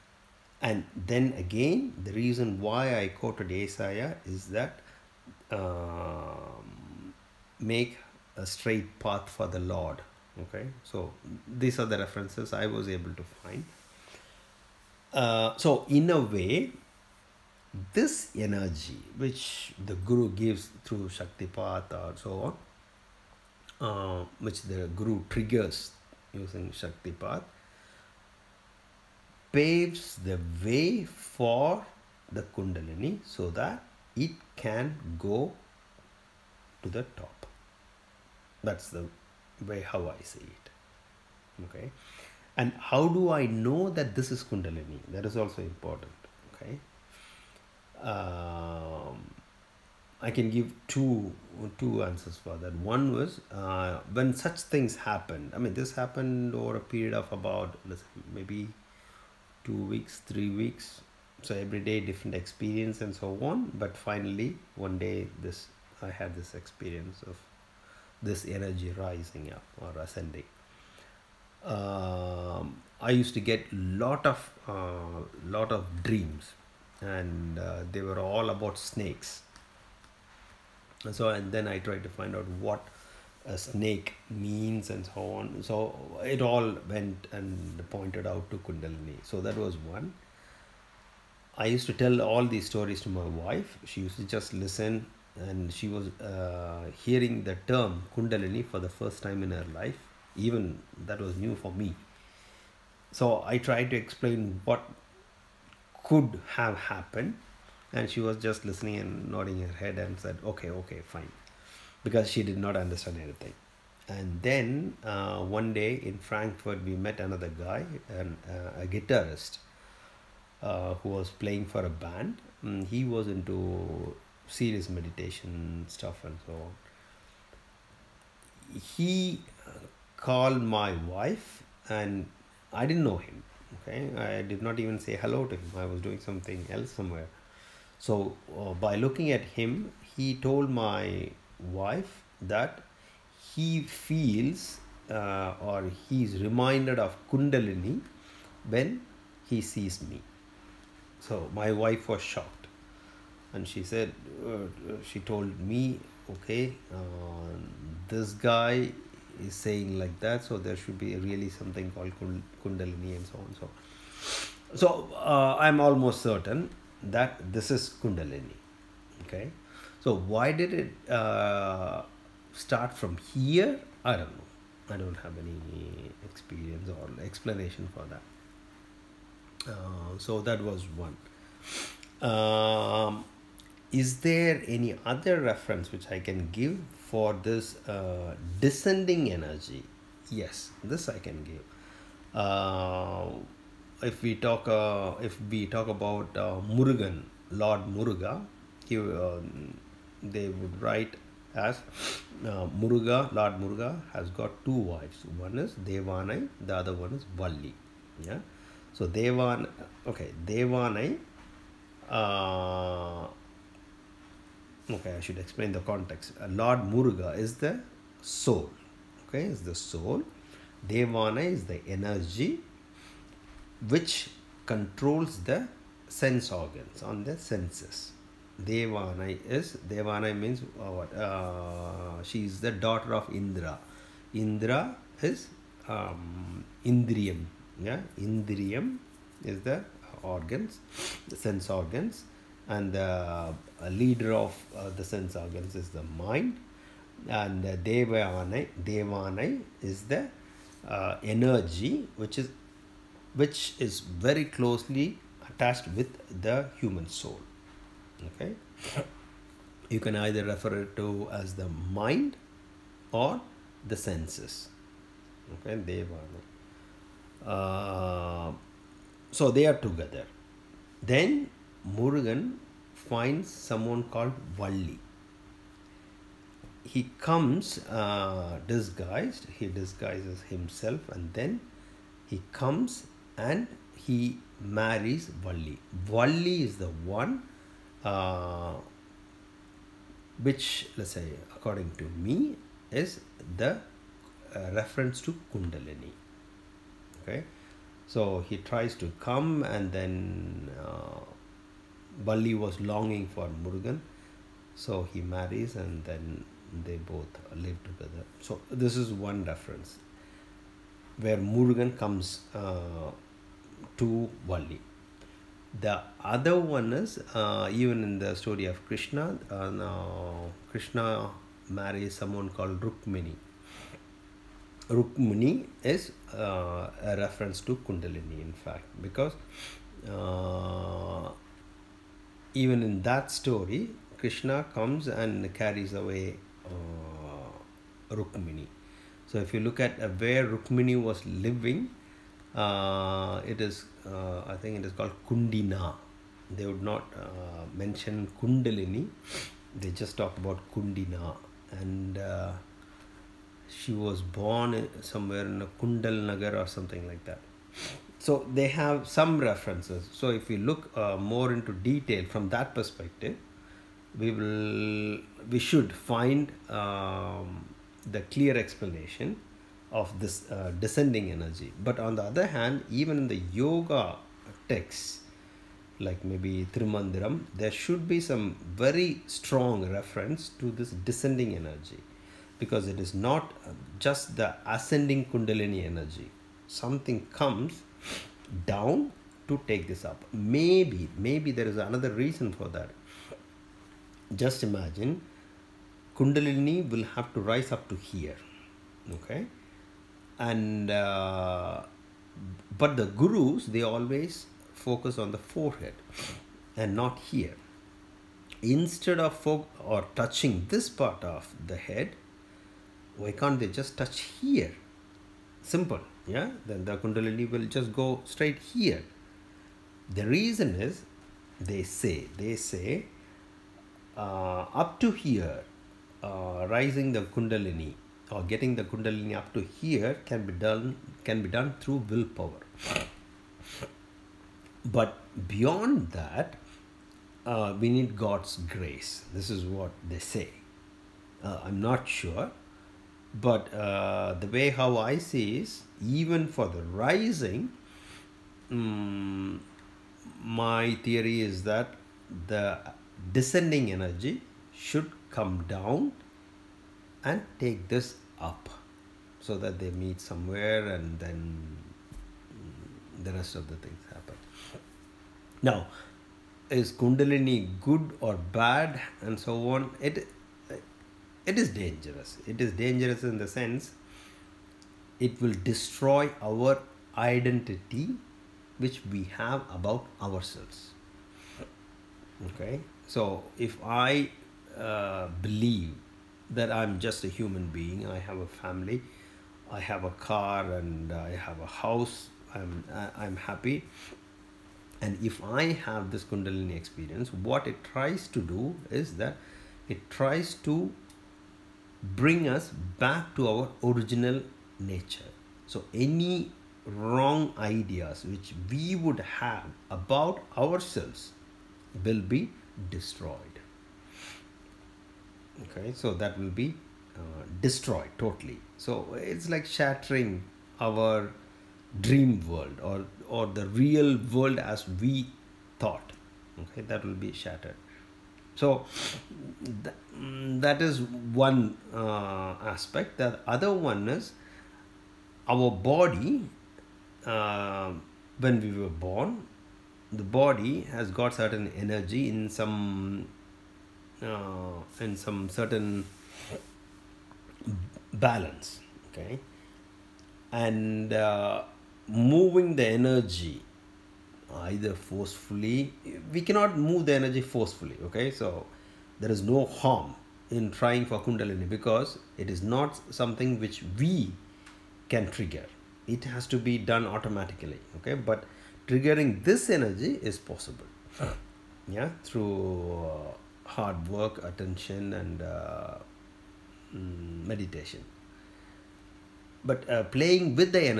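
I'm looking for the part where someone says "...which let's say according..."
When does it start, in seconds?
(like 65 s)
290 s.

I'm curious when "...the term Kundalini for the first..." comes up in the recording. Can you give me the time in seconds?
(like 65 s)
97 s.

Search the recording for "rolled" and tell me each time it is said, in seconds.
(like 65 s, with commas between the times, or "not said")
not said.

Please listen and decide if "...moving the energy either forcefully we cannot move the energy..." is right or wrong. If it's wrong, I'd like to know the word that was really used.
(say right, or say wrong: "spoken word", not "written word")
right.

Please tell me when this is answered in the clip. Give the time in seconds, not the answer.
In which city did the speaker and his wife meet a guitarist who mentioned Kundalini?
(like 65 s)
116 s.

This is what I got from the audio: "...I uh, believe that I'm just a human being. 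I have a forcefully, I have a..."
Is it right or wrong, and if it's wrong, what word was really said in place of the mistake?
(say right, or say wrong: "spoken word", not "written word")
wrong: "family", not "forcefully".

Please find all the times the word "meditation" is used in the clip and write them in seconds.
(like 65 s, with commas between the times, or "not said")
124 s, 577 s.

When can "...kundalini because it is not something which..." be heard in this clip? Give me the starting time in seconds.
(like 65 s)
561 s.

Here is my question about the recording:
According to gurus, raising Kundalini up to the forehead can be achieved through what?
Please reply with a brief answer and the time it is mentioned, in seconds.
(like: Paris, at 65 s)
Willpower, at 432 s.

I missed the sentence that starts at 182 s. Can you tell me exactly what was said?
Um, is there any other reference which I can give for this uh, descending energy?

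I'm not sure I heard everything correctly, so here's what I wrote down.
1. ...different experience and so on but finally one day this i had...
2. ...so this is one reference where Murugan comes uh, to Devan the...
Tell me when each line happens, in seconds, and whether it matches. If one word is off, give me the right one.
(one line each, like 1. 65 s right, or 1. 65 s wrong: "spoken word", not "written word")
1. 61 s right
2. 308 s wrong: "Valli", not "Devan".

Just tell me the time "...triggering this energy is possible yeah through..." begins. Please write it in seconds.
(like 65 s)
568 s.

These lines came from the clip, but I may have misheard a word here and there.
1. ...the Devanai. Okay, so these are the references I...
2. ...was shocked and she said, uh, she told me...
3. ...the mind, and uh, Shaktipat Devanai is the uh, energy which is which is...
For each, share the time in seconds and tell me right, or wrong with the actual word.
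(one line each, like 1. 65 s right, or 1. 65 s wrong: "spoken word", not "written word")
1. 9 s wrong: "Lord", not "Devanai"
2. 152 s right
3. 245 s wrong: "Devanai", not "Shaktipat".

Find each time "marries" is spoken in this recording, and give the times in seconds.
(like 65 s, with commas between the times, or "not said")
284 s, 305 s, 321 s.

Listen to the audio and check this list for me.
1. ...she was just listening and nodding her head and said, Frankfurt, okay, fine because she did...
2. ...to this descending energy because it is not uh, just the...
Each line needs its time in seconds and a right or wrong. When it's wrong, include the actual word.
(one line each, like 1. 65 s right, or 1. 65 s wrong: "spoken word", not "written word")
1. 108 s wrong: "Okay", not "Frankfurt"
2. 380 s right.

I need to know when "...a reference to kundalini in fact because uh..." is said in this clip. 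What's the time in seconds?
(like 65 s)
327 s.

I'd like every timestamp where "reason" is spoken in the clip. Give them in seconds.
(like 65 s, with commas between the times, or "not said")
2 s, 392 s, 420 s.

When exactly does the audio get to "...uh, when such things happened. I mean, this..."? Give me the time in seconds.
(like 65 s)
53 s.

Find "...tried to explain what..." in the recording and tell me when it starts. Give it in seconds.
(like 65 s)
103 s.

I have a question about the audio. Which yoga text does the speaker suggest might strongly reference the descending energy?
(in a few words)
Thirumandiram.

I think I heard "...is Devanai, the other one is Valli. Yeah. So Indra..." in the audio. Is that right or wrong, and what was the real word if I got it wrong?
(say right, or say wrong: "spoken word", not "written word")
wrong: "Devan", not "Indra".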